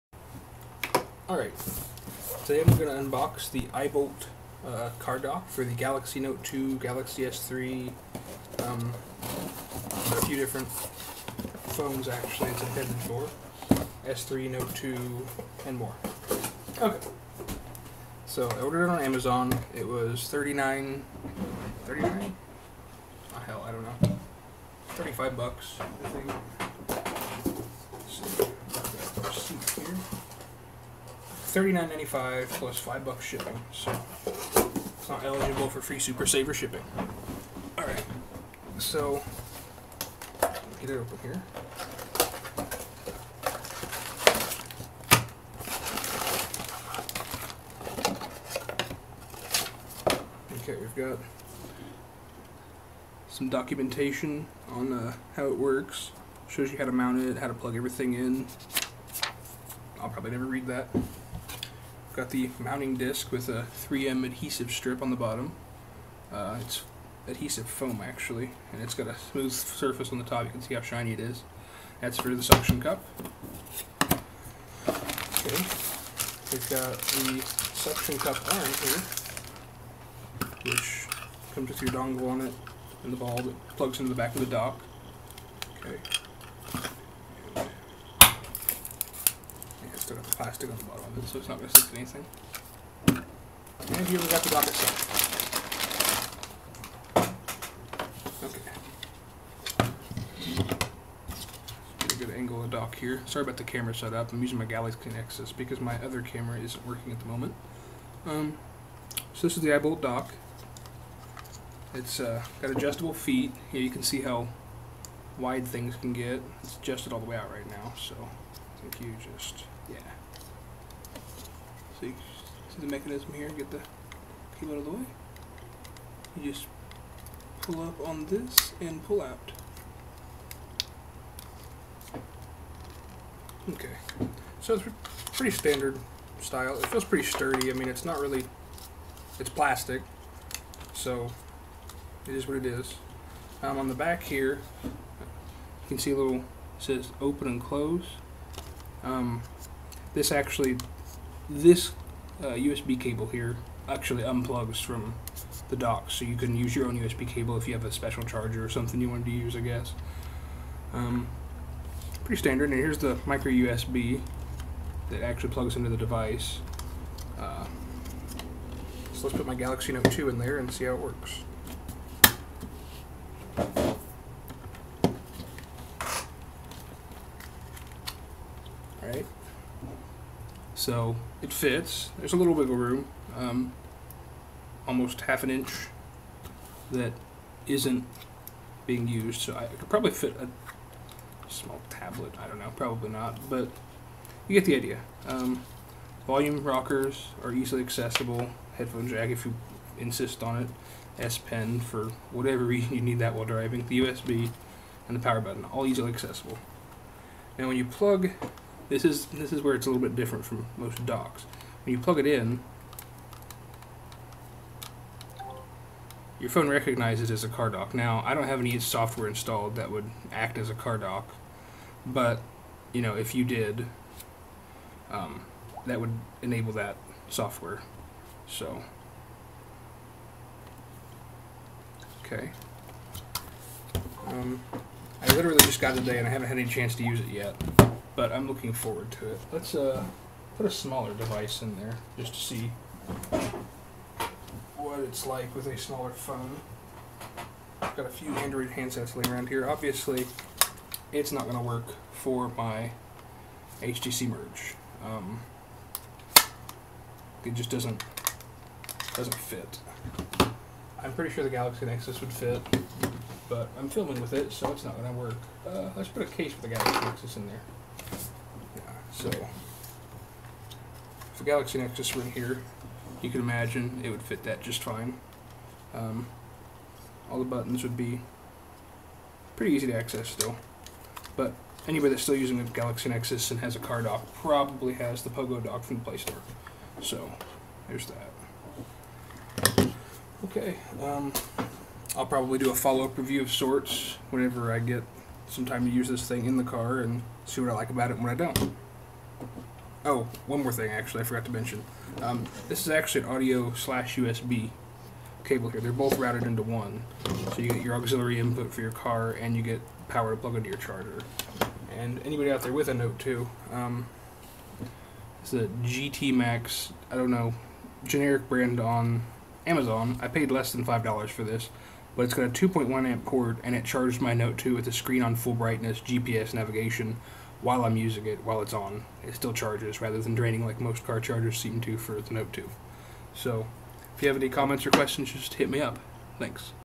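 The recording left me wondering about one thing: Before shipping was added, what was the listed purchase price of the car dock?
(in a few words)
$39.95.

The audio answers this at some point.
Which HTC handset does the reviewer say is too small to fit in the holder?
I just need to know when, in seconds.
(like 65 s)
253 s.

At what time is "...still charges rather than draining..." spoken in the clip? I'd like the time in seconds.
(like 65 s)
329 s.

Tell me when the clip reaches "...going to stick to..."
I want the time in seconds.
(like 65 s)
91 s.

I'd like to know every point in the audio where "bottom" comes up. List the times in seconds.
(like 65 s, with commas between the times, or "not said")
65 s, 90 s.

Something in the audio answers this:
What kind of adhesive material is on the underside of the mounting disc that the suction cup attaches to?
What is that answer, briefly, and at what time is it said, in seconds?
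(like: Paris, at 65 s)
adhesive foam, at 67 s.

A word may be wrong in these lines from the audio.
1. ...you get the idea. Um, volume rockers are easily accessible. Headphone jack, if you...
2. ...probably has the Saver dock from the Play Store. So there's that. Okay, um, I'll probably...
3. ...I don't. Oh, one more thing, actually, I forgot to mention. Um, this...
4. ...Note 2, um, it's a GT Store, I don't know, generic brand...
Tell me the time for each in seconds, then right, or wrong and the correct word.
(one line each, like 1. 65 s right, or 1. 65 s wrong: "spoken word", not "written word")
1. 194 s right
2. 284 s wrong: "Pogo", not "Saver"
3. 298 s right
4. 312 s wrong: "Max", not "Store".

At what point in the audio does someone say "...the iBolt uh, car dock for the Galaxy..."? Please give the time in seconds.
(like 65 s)
3 s.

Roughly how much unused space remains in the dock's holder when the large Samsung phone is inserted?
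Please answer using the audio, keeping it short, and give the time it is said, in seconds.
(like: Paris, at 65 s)
half an inch, at 185 s.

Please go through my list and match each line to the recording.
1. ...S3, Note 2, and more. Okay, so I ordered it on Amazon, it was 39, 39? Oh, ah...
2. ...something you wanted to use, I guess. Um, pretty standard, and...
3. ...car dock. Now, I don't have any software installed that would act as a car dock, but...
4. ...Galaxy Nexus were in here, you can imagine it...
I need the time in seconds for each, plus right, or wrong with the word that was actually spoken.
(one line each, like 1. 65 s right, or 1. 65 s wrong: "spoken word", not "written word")
1. 14 s right
2. 158 s right
3. 217 s right
4. 271 s right.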